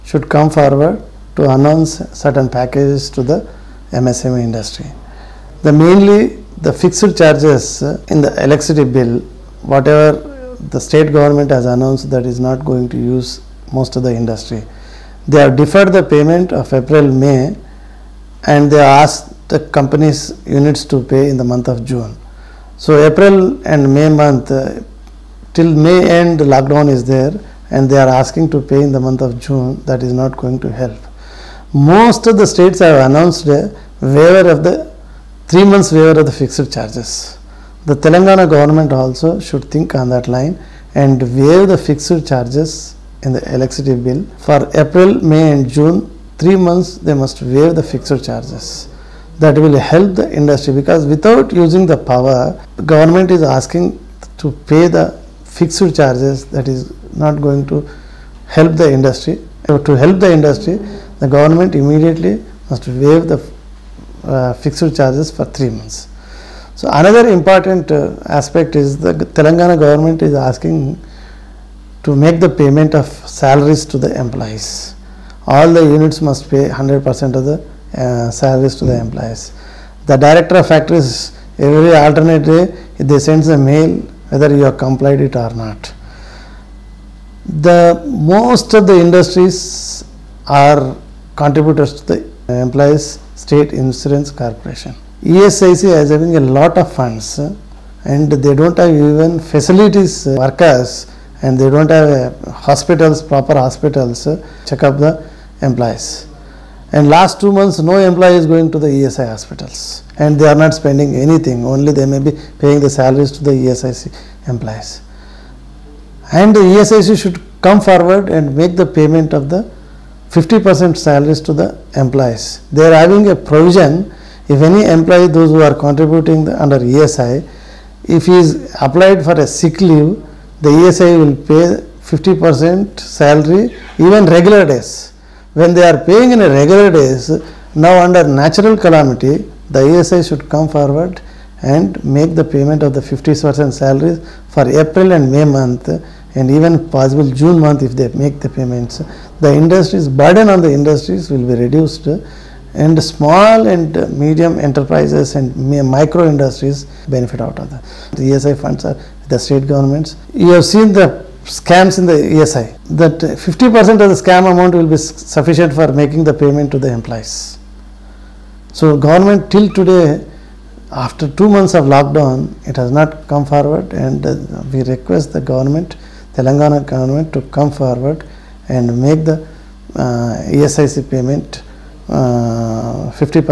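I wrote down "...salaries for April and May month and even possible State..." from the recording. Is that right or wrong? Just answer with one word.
wrong.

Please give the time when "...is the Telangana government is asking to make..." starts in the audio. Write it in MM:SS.
01:08.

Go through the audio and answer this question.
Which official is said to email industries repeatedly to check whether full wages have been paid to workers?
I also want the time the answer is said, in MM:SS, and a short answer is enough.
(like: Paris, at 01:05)
Director of factories, at 01:20.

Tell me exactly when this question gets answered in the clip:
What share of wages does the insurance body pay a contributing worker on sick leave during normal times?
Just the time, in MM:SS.
02:10.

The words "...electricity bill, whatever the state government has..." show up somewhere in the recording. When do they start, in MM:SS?
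00:08.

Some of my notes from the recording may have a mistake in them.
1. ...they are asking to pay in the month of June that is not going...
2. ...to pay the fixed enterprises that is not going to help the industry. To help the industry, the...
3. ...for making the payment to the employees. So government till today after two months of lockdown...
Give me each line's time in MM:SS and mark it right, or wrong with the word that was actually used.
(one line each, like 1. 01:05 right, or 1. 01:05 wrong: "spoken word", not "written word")
1. 00:27 right
2. 00:54 wrong: "charges", not "enterprises"
3. 02:45 right.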